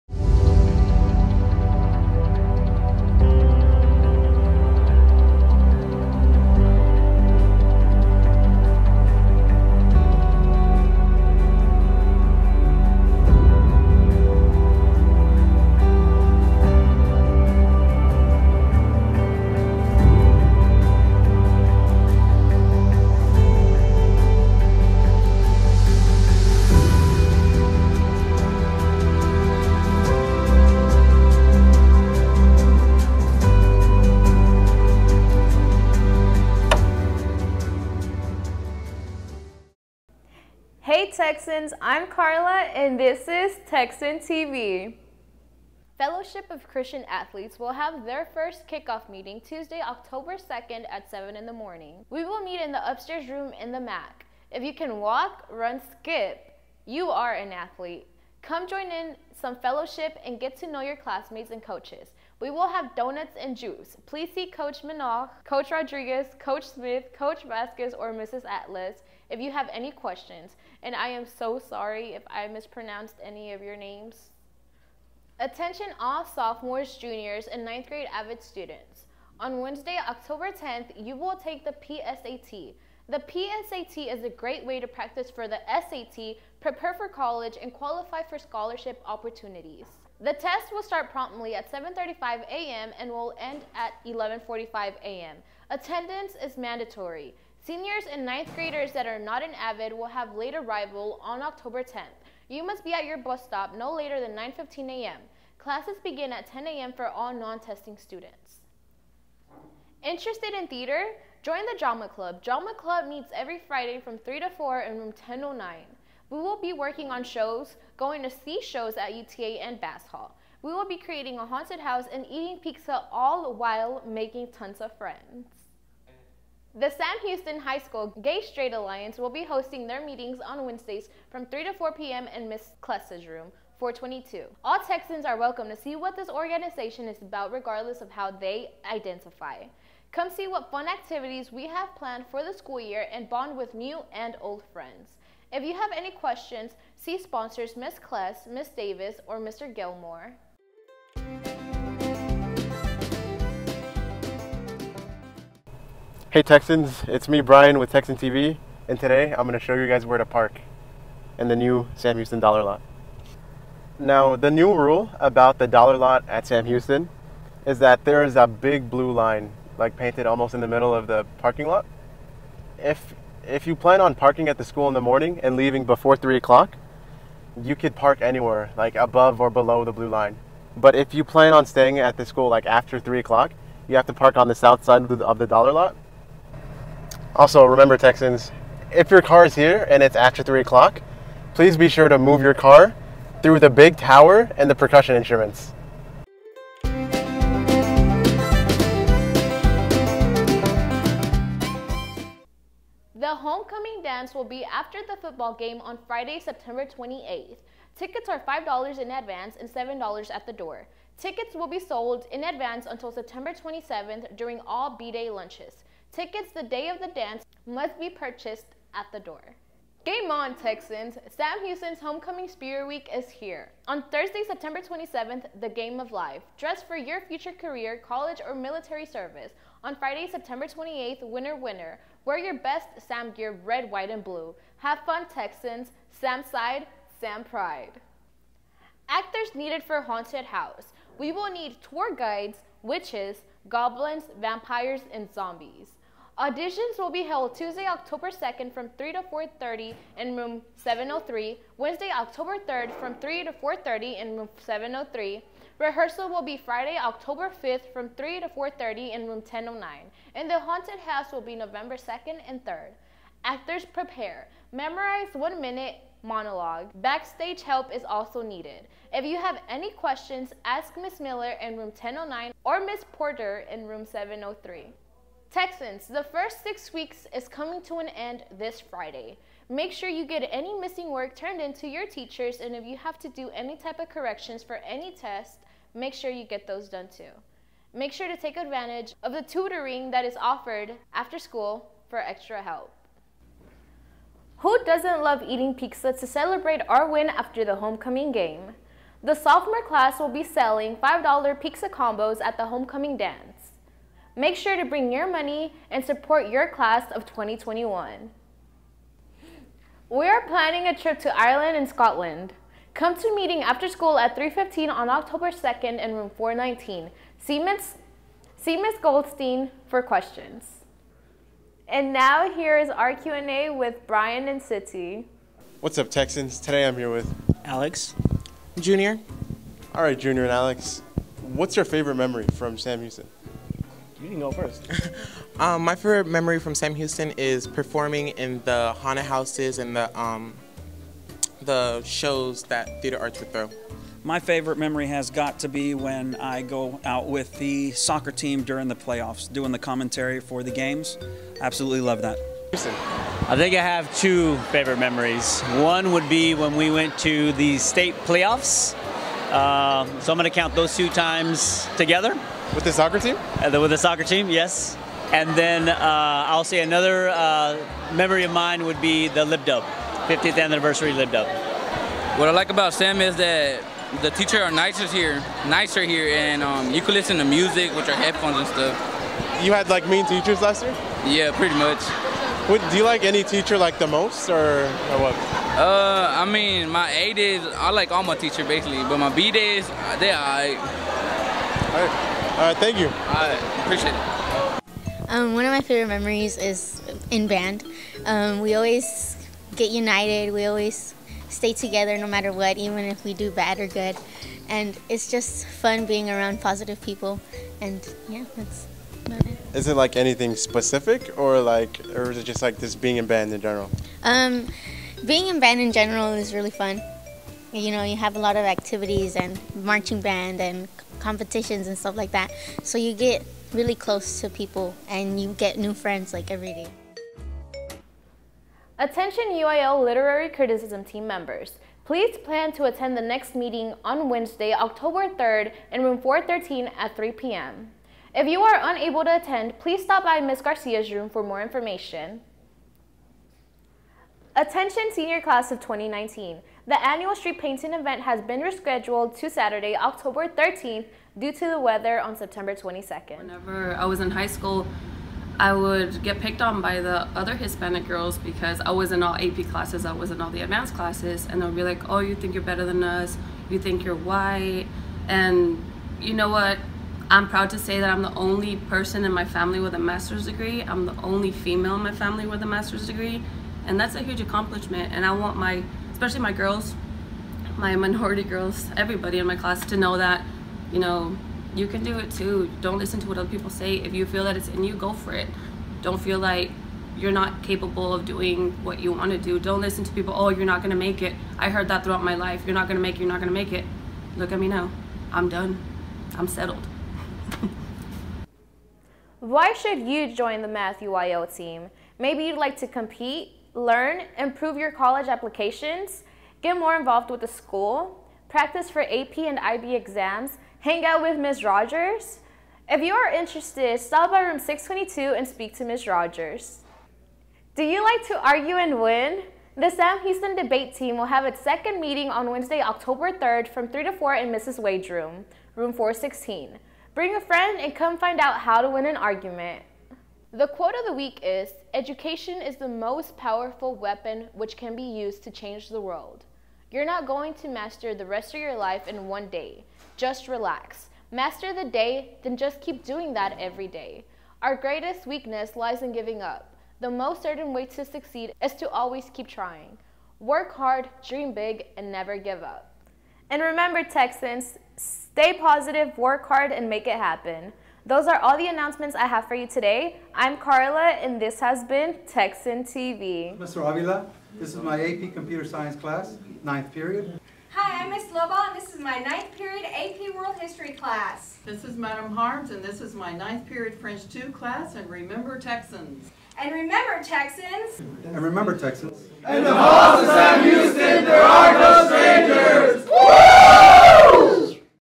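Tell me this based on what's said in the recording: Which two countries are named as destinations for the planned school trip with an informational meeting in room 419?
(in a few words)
Ireland and Scotland.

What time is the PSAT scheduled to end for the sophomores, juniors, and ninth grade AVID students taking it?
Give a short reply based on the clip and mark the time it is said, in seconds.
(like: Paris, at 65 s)
11:45 a.m., at 94 s.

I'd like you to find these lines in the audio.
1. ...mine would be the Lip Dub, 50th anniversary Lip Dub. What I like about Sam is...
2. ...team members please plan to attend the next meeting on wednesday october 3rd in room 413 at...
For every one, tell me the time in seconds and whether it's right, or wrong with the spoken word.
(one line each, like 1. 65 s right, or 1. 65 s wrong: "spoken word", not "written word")
1. 368 s right
2. 431 s right.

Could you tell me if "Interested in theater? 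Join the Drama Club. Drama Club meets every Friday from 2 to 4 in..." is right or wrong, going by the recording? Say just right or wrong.
wrong.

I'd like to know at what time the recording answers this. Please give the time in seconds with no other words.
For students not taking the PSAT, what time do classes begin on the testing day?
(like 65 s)
106 s.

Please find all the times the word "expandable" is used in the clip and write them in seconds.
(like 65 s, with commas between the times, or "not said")
not said.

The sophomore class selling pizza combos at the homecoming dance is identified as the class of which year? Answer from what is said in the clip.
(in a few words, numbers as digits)
2021.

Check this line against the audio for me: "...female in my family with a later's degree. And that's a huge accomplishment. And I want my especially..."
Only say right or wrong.
wrong.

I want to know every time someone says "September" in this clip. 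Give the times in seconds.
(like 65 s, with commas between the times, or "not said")
206 s, 213 s, 224 s, 230 s, 452 s.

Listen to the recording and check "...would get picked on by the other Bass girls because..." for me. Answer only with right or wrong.
wrong.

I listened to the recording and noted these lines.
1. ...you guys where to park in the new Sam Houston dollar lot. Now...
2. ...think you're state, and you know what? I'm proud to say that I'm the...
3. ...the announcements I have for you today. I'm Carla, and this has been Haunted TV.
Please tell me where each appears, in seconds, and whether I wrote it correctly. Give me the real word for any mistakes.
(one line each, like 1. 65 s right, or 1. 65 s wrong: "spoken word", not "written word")
1. 159 s right
2. 463 s wrong: "white", not "state"
3. 558 s wrong: "Texan", not "Haunted".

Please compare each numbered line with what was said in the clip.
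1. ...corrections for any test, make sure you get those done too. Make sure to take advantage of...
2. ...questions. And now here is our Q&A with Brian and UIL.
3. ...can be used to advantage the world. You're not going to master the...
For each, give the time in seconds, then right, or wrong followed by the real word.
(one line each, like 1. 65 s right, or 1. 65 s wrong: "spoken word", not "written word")
1. 284 s right
2. 320 s wrong: "City", not "UIL"
3. 534 s wrong: "change", not "advantage".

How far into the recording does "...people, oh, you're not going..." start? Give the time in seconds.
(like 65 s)
490 s.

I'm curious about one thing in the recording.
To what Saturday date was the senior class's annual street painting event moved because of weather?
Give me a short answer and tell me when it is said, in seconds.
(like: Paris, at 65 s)
October 13th, at 449 s.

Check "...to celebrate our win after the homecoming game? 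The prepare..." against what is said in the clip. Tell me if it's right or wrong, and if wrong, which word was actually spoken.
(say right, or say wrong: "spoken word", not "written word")
wrong: "sophomore", not "prepare".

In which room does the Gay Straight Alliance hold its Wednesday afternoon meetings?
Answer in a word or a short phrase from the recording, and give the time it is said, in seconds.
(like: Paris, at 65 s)
422, at 133 s.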